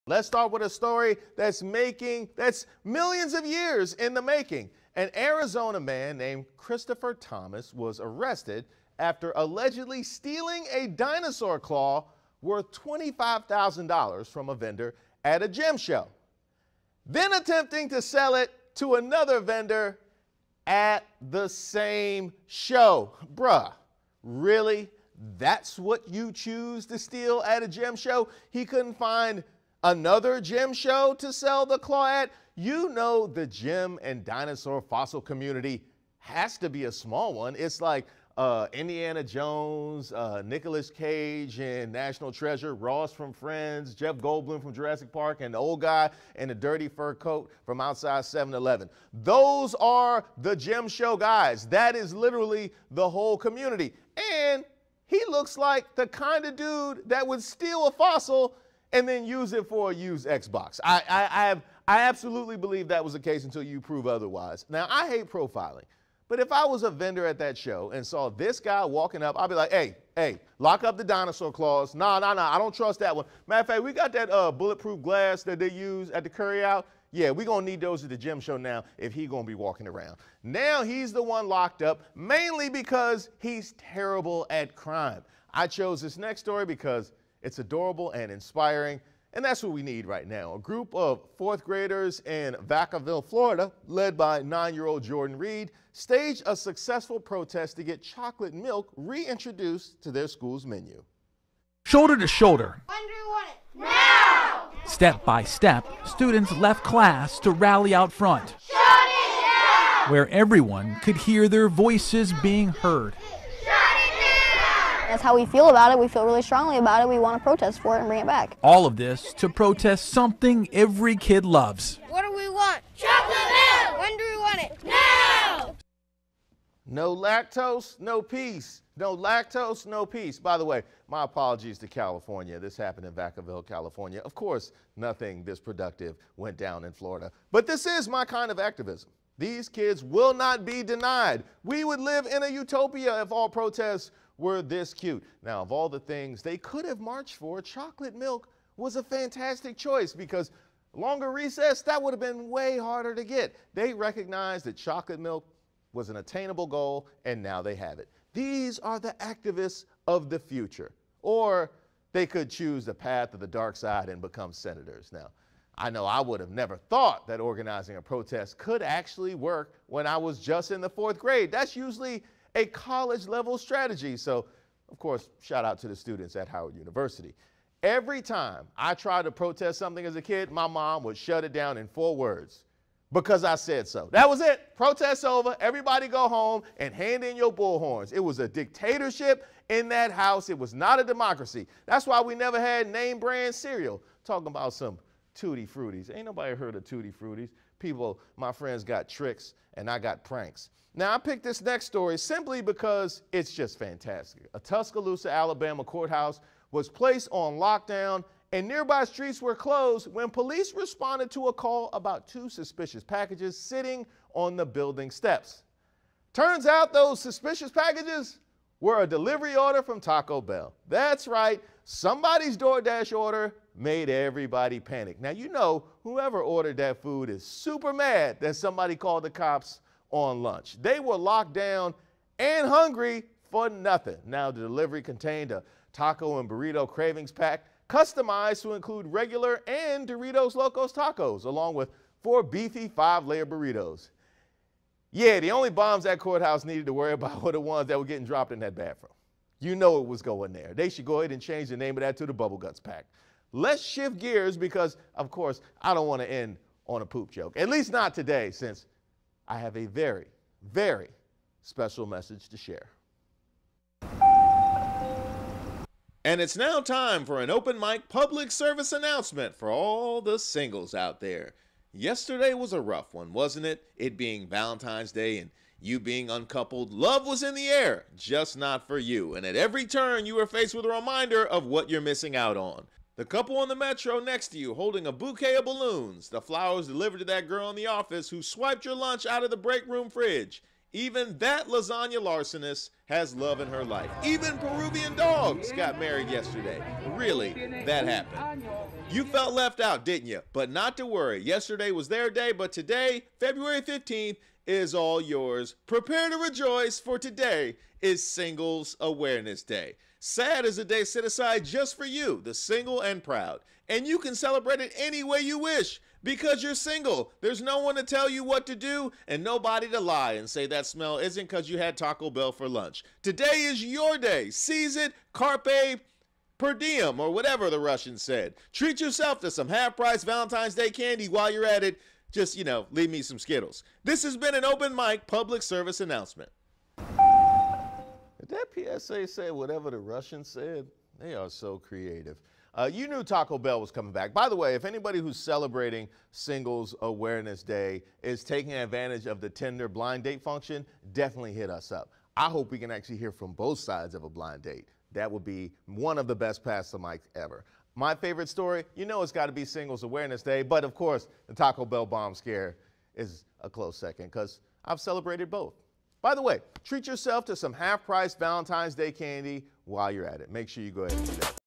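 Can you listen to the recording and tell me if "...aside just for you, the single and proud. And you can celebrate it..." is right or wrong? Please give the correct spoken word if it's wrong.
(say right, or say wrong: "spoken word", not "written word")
right.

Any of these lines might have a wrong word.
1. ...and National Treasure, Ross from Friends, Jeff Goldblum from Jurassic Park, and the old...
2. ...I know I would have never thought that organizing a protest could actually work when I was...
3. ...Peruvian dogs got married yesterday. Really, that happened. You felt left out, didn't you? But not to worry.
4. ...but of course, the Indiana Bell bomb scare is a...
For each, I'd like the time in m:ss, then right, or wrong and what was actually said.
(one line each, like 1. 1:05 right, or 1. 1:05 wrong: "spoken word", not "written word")
1. 0:41 right
2. 2:45 right
3. 4:54 right
4. 6:00 wrong: "Taco", not "Indiana".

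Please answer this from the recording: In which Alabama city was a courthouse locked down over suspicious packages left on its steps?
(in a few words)
Tuscaloosa.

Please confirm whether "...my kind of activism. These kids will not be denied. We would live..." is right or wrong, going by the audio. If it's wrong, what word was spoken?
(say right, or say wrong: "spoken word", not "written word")
right.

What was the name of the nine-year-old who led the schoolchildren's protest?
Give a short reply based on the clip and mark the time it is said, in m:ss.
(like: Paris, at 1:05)
Jordan Reed, at 1:35.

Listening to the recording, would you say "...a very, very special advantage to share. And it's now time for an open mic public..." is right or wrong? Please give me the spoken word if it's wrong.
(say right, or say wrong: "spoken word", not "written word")
wrong: "message", not "advantage".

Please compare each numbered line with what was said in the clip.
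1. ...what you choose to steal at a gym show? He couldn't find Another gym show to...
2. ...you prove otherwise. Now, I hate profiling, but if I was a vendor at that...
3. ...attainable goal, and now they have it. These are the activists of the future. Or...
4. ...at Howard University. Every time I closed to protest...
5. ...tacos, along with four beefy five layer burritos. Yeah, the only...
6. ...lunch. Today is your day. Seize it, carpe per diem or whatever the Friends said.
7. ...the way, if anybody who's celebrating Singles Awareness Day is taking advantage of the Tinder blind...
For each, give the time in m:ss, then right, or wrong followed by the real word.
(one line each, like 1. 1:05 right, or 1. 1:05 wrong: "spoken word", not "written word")
1. 0:25 right
2. 1:03 right
3. 2:36 right
4. 2:56 wrong: "tried", not "closed"
5. 4:00 right
6. 5:22 wrong: "Russian", not "Friends"
7. 5:44 right.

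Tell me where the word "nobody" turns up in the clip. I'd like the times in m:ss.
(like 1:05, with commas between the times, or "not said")
3:16, 5:19.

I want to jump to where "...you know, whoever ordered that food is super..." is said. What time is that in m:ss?
3:45.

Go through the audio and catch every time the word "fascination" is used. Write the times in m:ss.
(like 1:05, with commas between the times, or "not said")
not said.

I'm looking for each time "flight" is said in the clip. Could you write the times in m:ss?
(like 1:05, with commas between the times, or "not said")
not said.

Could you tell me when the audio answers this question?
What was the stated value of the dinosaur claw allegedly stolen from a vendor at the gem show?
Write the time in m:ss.
0:12.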